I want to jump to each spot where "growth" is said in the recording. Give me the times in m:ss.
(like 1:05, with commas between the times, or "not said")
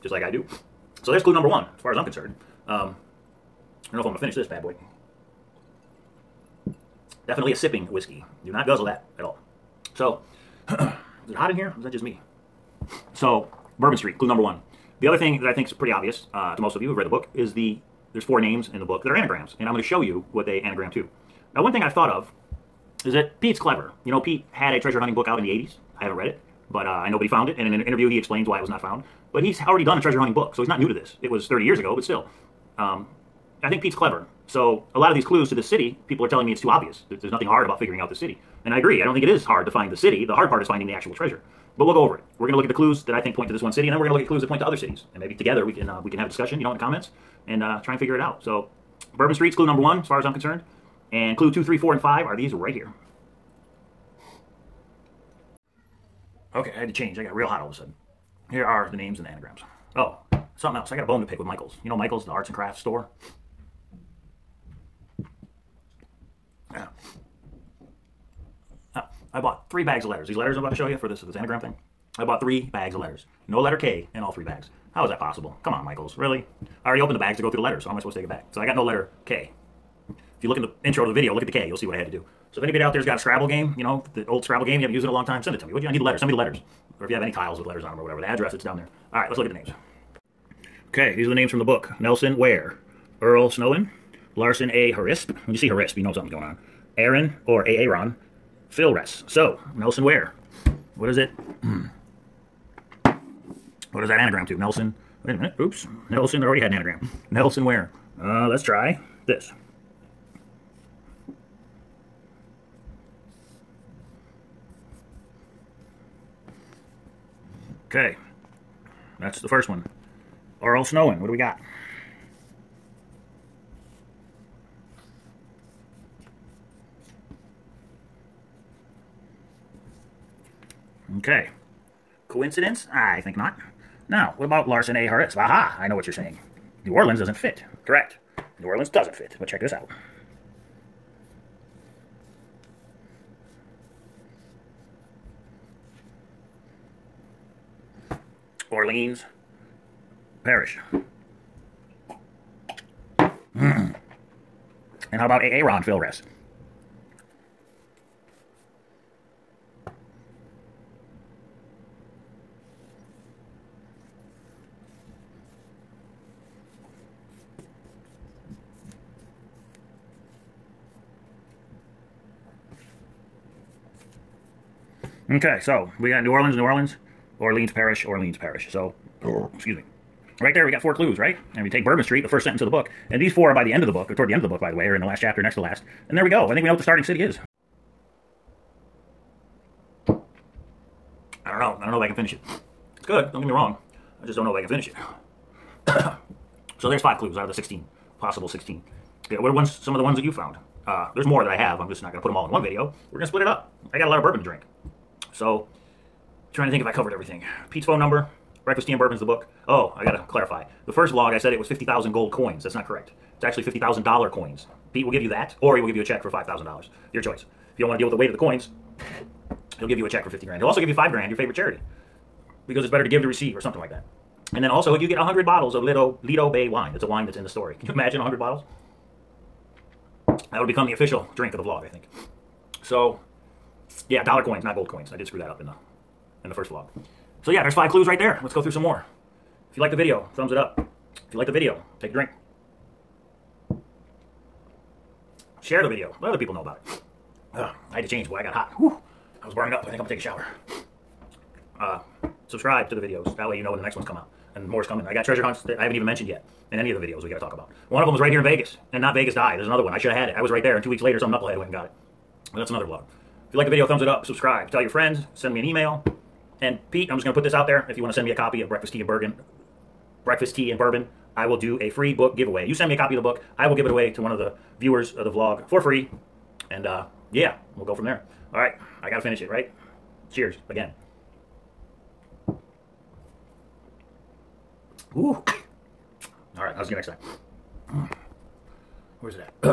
not said.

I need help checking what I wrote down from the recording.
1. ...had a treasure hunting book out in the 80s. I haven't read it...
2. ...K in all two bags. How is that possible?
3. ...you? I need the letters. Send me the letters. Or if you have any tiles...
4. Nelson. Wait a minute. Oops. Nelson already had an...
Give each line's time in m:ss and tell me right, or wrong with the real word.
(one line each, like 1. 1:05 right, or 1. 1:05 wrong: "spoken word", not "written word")
1. 0:24 right
2. 1:13 wrong: "three", not "two"
3. 1:25 right
4. 1:44 right.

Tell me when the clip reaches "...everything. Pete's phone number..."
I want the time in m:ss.
3:27.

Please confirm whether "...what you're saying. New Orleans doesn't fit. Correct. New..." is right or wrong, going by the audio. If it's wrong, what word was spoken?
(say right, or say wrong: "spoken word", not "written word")
right.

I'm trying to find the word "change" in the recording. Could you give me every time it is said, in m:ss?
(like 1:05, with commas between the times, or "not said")
0:56, 4:08.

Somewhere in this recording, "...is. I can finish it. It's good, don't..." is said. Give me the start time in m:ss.
3:07.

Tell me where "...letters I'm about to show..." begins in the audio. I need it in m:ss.
1:10.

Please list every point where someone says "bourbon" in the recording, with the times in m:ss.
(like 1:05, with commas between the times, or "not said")
0:13, 0:49, 3:01, 3:24, 3:28, 4:30.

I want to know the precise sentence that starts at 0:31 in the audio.
It was 30 years ago, but still.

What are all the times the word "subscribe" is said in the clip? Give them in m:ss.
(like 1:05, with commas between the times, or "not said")
4:12, 4:24.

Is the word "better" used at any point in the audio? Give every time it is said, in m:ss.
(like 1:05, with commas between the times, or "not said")
3:42.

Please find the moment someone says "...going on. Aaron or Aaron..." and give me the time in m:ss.
1:36.